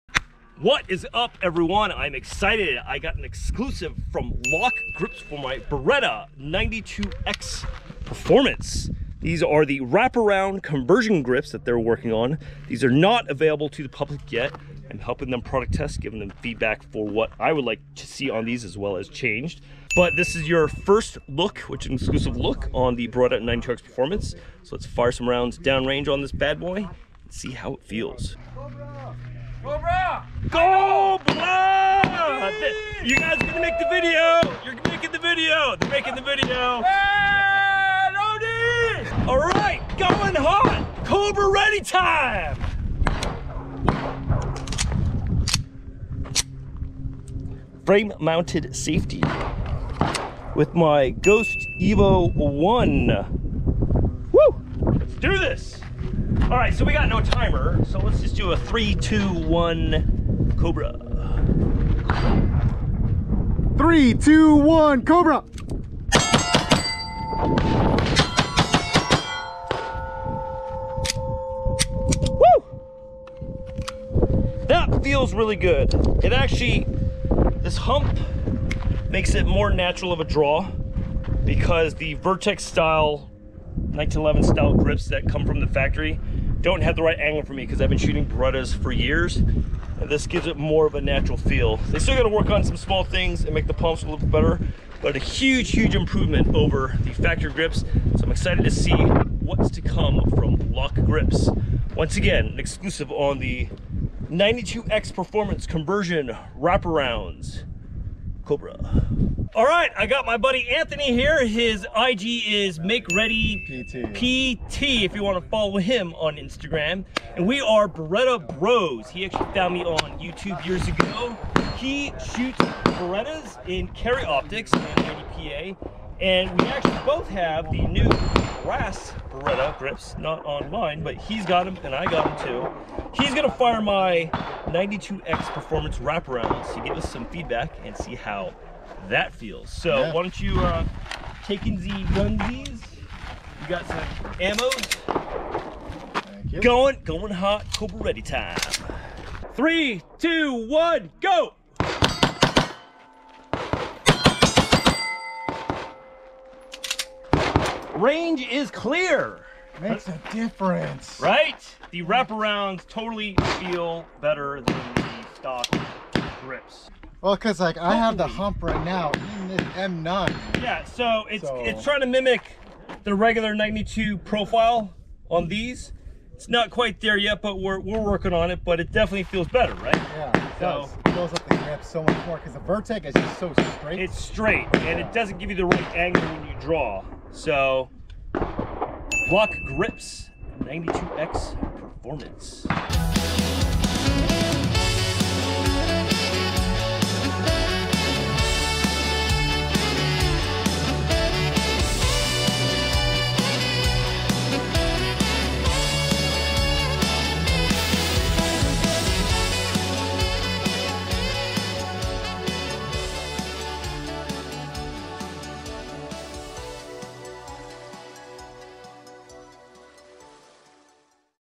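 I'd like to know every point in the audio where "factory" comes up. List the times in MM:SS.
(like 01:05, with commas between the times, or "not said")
01:25, 01:37.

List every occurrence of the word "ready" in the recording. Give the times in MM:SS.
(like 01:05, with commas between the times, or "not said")
00:41, 01:53, 02:28.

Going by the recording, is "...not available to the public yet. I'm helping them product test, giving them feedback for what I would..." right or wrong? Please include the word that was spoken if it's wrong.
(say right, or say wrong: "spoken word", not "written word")
right.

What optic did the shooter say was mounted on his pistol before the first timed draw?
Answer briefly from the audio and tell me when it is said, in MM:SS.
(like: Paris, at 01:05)
Ghost Evo 1, at 00:51.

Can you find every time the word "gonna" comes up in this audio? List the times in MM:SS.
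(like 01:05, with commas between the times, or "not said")
00:33, 02:13.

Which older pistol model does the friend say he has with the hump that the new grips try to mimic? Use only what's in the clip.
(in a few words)
M9.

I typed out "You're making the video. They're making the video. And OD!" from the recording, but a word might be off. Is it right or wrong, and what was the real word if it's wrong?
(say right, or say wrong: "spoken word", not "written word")
right.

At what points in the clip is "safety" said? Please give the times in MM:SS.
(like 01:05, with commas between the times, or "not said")
00:48.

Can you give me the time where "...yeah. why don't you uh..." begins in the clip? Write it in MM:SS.
02:19.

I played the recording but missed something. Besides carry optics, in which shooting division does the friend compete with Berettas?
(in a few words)
PA.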